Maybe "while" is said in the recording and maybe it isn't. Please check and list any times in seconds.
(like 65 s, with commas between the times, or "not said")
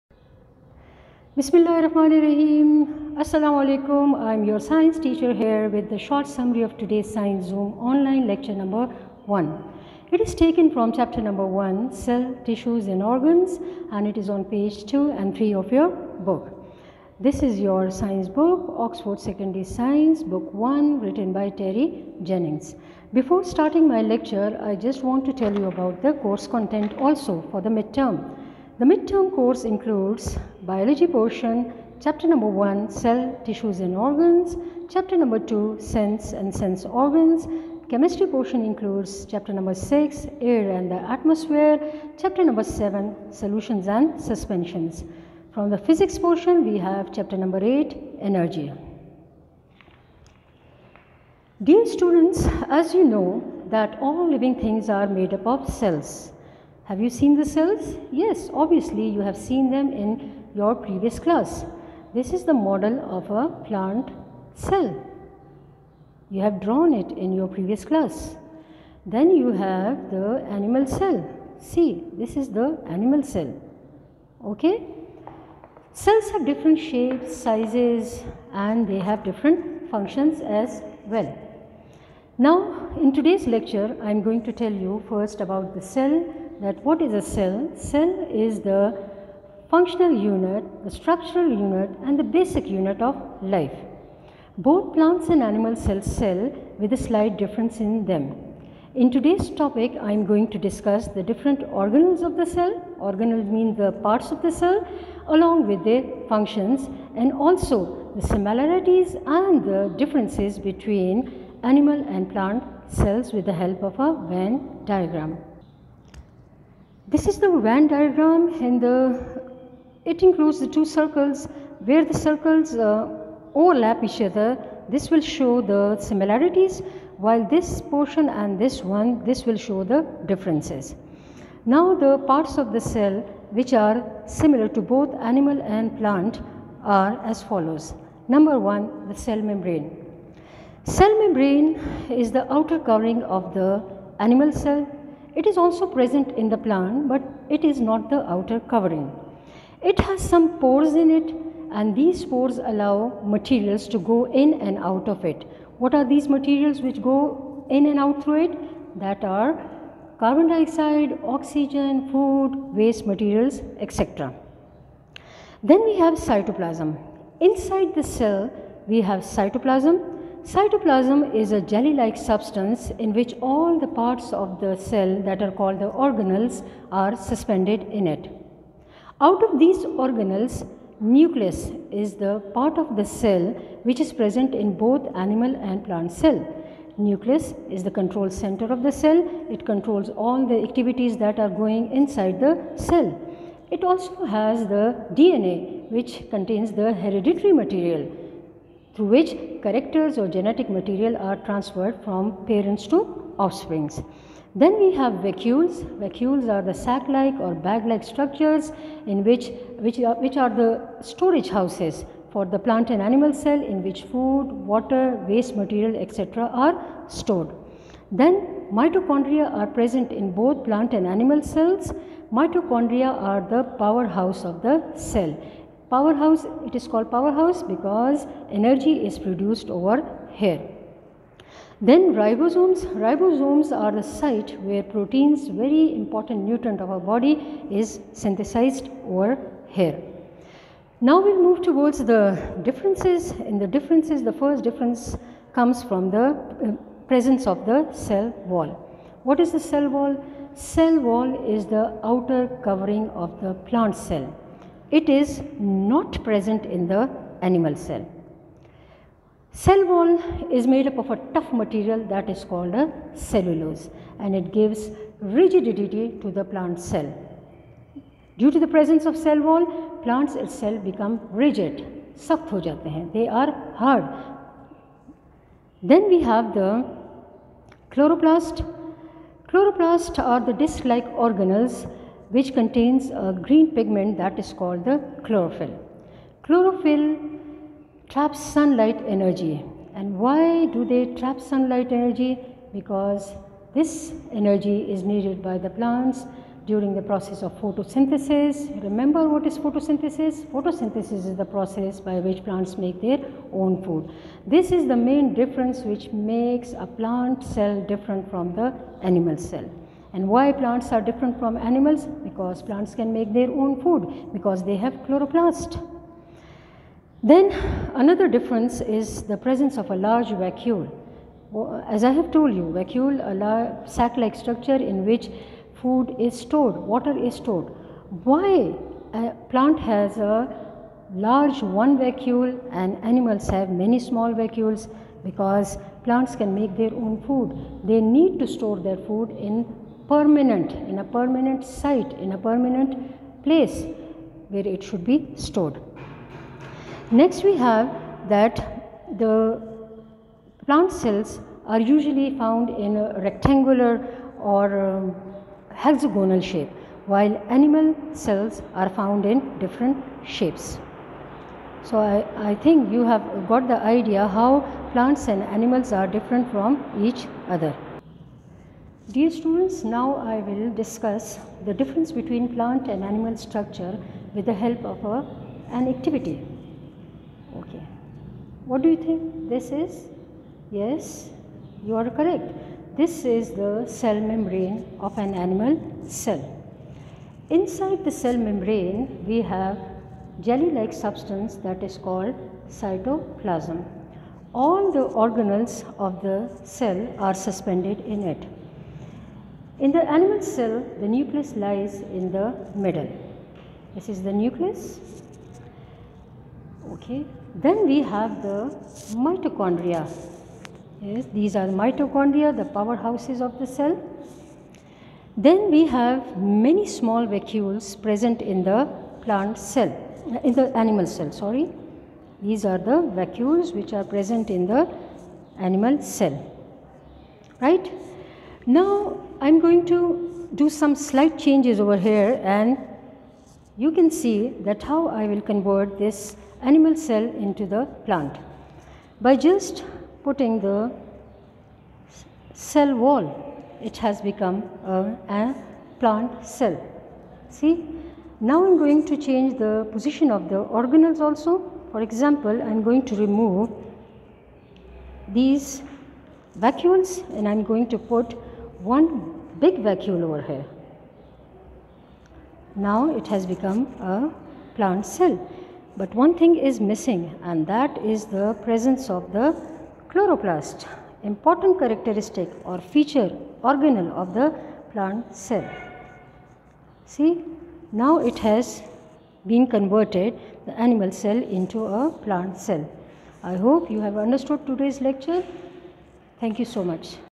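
127 s, 357 s.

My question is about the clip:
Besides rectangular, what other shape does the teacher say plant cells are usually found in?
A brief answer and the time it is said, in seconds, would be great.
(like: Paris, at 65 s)
Hexagonal, at 355 s.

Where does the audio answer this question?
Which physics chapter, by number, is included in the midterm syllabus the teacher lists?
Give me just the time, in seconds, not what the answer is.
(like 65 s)
47 s.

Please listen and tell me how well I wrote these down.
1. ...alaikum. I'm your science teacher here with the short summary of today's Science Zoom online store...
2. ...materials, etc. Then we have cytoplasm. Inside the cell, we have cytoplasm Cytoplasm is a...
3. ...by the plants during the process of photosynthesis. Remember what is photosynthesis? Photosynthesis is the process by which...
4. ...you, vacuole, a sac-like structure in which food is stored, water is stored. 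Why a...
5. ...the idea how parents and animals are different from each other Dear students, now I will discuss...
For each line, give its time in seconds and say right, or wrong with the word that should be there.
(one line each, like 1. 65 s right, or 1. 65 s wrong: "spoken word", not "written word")
1. 3 s wrong: "lecture", not "store"
2. 163 s right
3. 295 s right
4. 322 s right
5. 363 s wrong: "plants", not "parents".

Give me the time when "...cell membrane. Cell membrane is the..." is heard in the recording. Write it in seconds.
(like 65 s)
139 s.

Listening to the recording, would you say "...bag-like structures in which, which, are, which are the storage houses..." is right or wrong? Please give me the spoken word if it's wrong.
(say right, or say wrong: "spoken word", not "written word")
right.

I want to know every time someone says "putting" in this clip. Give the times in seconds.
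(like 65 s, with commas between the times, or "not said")
440 s.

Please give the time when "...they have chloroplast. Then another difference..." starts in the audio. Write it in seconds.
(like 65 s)
314 s.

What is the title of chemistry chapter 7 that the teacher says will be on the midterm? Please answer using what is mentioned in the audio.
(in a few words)
Solutions and suspensions.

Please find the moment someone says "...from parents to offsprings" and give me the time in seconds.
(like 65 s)
202 s.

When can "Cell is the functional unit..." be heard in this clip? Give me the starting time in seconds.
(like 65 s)
87 s.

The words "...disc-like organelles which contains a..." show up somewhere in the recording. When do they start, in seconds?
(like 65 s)
280 s.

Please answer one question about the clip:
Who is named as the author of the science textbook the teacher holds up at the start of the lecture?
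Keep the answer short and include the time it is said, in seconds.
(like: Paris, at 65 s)
Terry Jennings, at 21 s.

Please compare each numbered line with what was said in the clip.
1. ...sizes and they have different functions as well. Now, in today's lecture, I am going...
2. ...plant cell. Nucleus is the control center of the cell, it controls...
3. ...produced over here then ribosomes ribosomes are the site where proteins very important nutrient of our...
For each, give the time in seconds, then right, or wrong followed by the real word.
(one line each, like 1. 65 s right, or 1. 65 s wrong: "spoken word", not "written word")
1. 77 s right
2. 185 s right
3. 229 s right.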